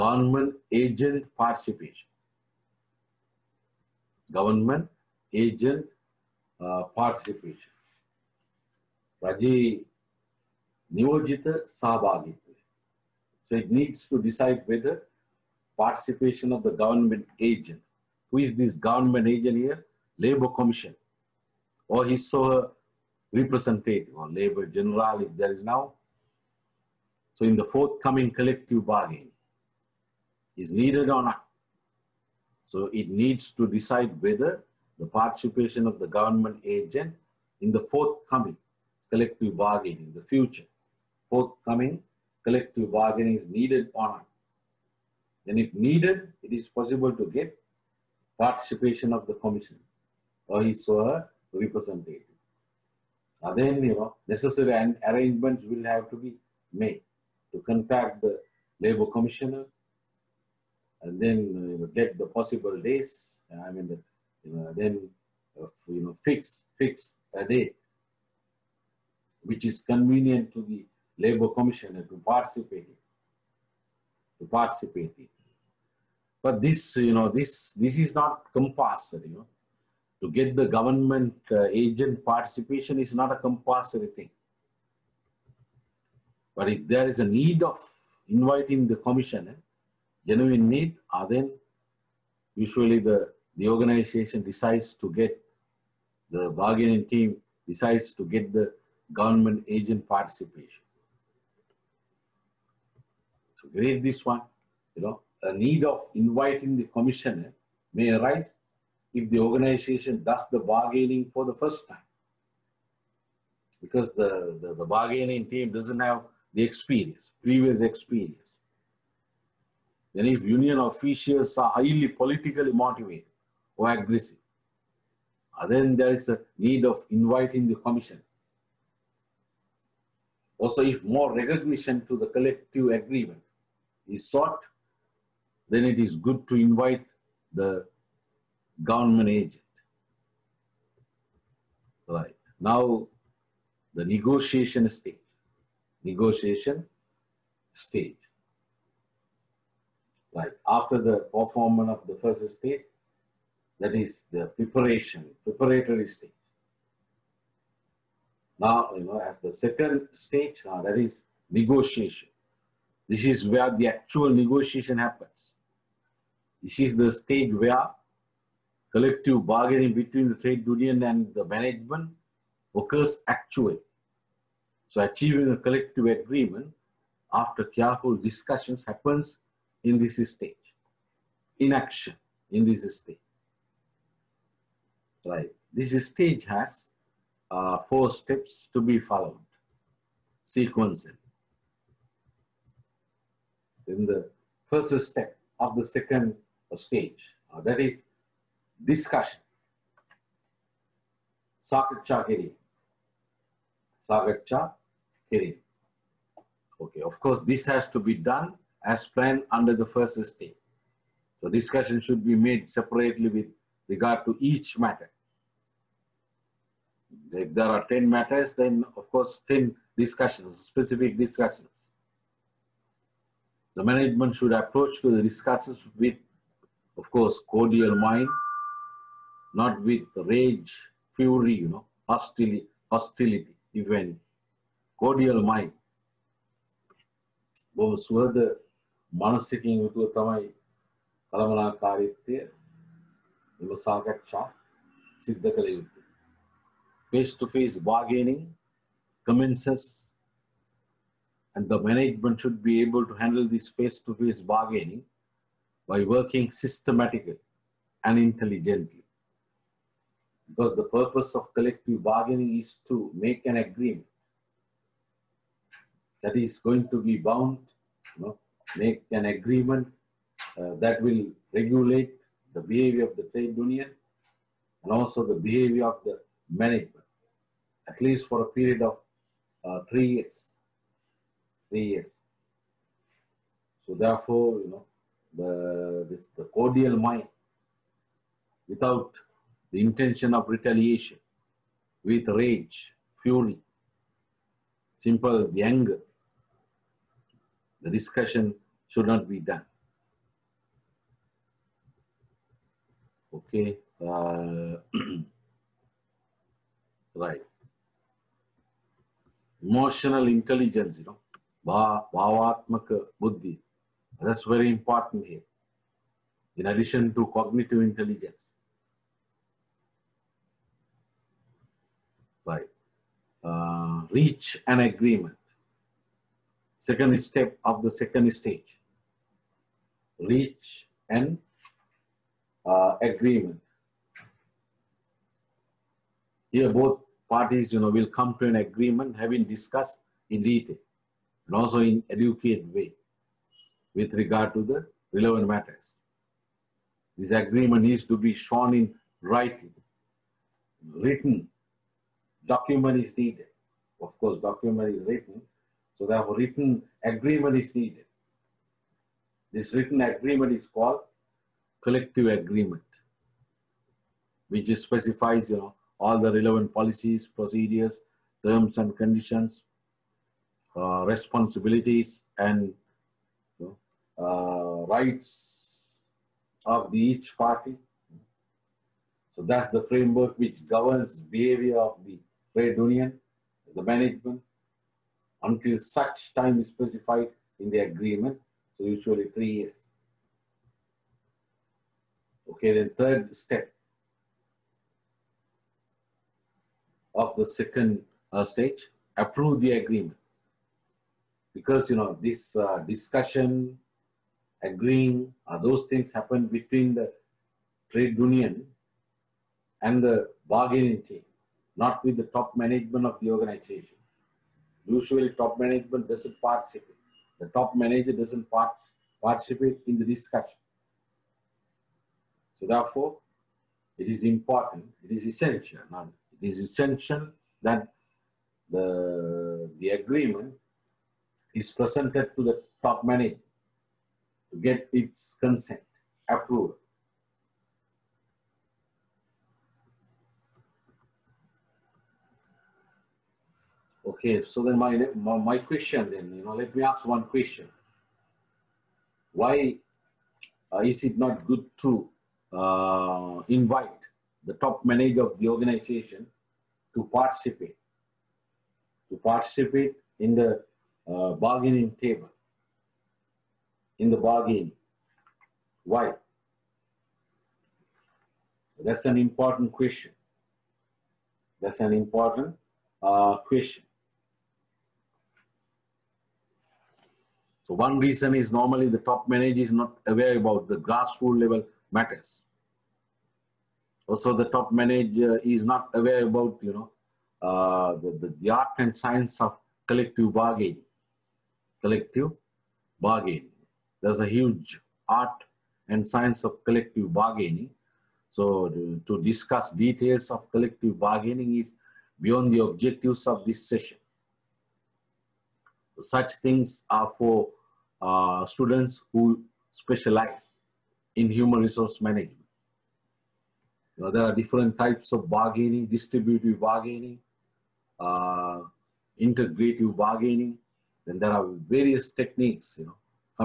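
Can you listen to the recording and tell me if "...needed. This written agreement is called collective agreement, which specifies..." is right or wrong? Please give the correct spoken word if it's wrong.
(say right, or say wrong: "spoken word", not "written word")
right.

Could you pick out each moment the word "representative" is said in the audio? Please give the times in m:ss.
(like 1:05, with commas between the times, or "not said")
0:23, 0:51.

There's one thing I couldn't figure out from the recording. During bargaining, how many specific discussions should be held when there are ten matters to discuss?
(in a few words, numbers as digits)
10.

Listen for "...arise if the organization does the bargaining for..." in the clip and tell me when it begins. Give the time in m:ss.
1:48.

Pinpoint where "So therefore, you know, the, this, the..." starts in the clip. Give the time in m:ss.
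4:43.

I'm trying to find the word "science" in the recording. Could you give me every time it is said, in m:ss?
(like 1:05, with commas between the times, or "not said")
8:08, 8:16.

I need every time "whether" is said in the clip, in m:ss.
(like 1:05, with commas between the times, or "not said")
0:14, 0:34.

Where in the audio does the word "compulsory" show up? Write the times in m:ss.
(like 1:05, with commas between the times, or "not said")
1:18, 1:23.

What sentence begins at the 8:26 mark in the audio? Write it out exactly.
Such things are for uh, students who specialize in human resource management.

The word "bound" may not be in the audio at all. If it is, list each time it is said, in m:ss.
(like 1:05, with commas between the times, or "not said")
4:27.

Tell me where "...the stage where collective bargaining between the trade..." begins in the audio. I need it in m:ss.
2:46.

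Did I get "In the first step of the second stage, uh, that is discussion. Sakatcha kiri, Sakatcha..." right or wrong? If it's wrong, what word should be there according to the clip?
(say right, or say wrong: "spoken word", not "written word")
right.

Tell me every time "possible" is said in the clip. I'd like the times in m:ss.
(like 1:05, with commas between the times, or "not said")
0:46, 1:02.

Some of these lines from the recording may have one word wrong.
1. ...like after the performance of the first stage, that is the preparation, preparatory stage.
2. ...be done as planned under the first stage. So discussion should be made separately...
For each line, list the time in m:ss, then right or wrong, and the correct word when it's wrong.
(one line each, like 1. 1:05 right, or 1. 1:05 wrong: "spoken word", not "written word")
1. 2:30 right
2. 3:27 right.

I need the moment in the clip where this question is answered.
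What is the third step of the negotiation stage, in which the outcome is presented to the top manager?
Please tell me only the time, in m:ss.
6:39.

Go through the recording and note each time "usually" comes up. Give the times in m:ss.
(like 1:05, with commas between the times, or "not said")
1:32, 6:28, 6:54.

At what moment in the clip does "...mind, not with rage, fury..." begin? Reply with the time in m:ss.
3:47.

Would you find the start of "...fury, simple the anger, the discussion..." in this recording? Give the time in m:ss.
4:53.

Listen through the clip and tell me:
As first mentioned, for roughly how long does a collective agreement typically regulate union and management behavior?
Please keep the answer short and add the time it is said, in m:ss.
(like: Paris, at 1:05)
3 years, at 4:39.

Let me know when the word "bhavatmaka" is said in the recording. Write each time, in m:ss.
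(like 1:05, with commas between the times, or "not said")
5:11.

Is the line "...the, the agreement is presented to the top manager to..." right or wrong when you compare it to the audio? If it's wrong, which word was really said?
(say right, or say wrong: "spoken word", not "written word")
right.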